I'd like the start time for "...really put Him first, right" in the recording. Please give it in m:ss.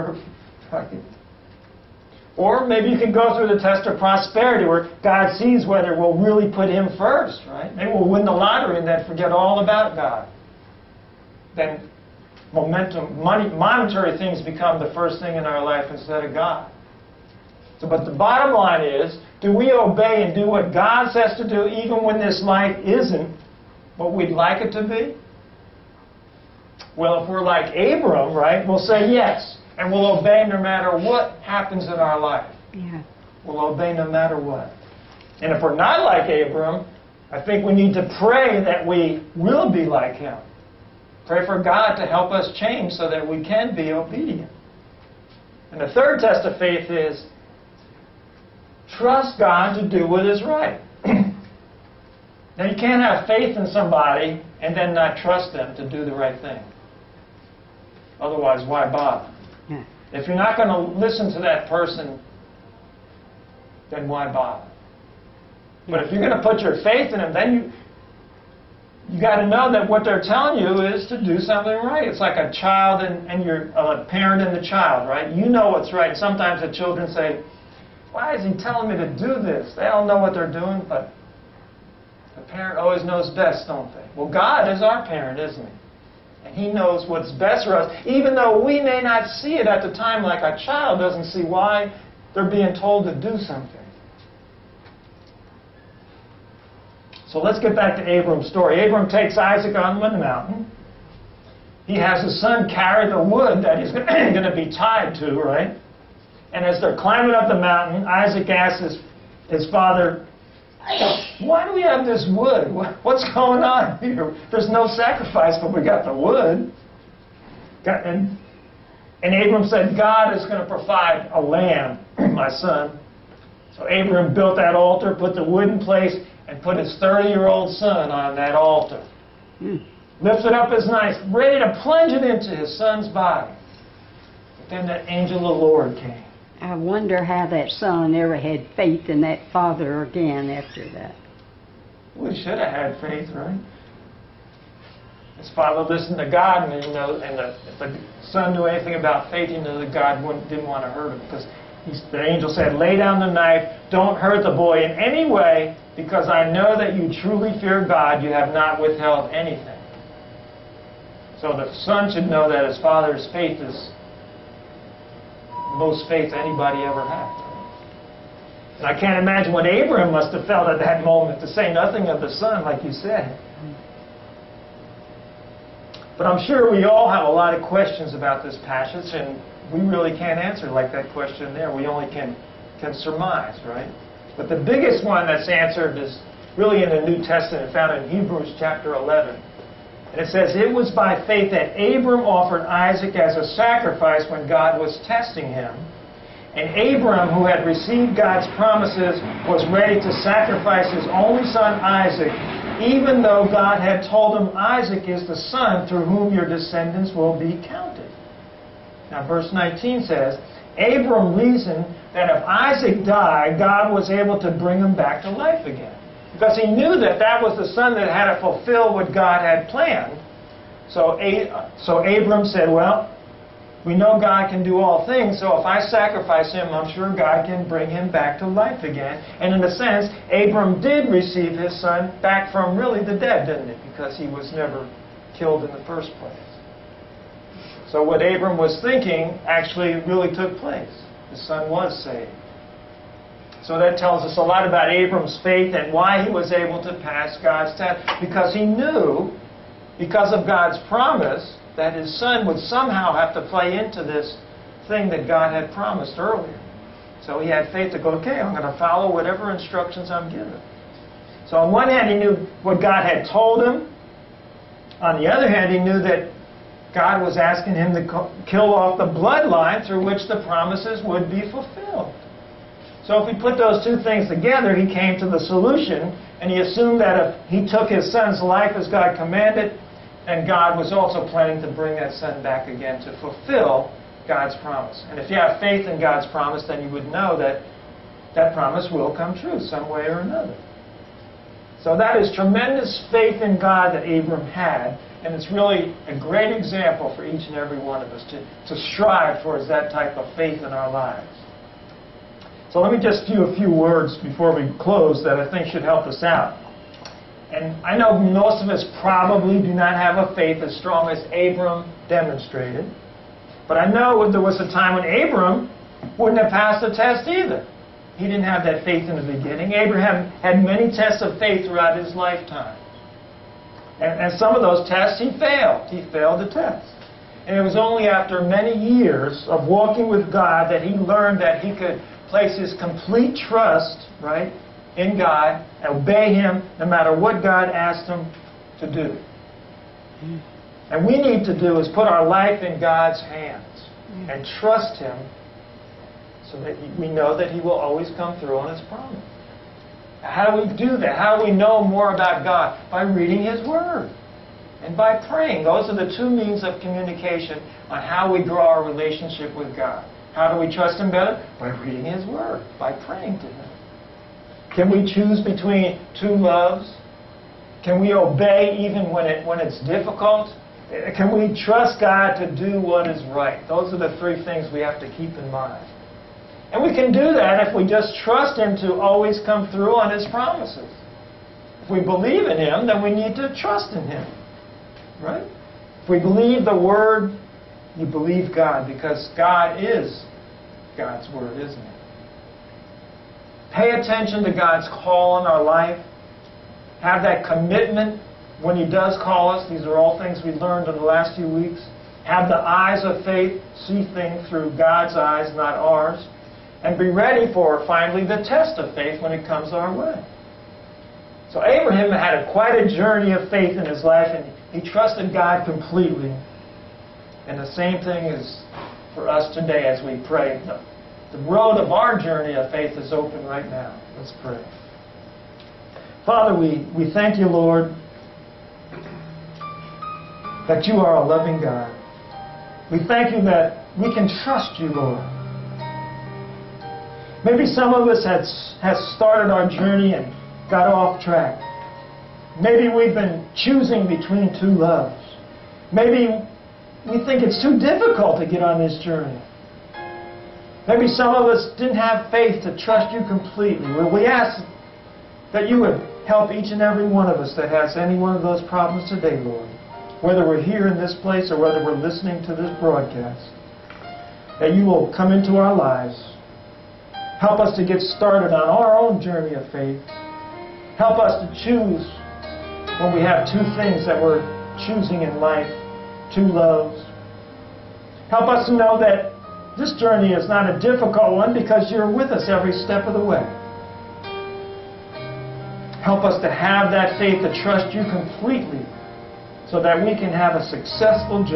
0:06.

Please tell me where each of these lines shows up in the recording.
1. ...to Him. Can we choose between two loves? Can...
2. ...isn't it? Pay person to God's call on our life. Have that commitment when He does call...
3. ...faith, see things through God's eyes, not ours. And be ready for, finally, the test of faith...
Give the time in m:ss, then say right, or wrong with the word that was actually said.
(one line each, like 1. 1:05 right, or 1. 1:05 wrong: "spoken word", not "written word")
1. 6:03 right
2. 6:31 wrong: "attention", not "person"
3. 6:43 right.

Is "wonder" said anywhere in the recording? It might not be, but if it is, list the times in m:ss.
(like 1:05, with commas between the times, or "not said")
2:16.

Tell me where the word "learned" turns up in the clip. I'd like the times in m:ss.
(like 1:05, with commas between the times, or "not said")
5:30, 6:40.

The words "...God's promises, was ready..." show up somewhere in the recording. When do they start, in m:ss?
3:18.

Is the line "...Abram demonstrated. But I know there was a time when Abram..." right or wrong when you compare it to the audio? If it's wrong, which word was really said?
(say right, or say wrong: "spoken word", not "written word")
right.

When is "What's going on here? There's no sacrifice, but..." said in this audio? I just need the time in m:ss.
1:53.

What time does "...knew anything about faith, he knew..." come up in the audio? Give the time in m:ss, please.
2:28.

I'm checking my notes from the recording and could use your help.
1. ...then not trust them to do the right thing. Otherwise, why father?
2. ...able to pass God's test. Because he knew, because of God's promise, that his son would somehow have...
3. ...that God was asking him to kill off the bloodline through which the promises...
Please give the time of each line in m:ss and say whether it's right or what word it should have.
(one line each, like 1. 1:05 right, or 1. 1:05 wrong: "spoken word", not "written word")
1. 0:54 wrong: "bother", not "father"
2. 4:06 right
3. 4:26 right.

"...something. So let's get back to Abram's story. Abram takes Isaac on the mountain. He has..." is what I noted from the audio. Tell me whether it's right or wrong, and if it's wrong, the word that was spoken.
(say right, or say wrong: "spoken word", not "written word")
right.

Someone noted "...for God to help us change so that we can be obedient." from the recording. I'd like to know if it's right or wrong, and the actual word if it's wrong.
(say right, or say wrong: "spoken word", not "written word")
right.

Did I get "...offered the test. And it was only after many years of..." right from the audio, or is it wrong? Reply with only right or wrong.
wrong.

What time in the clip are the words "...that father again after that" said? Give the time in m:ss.
2:19.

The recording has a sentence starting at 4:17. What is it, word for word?
So he had faith to go, okay, I'm going to follow whatever instructions I'm given.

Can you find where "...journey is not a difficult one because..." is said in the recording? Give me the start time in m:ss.
7:59.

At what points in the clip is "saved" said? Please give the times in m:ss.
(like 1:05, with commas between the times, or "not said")
4:02.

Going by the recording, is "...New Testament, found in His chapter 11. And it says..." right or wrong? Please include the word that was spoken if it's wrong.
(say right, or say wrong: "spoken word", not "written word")
wrong: "Hebrews", not "His".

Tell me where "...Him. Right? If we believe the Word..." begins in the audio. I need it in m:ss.
6:24.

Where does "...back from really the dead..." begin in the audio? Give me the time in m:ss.
3:52.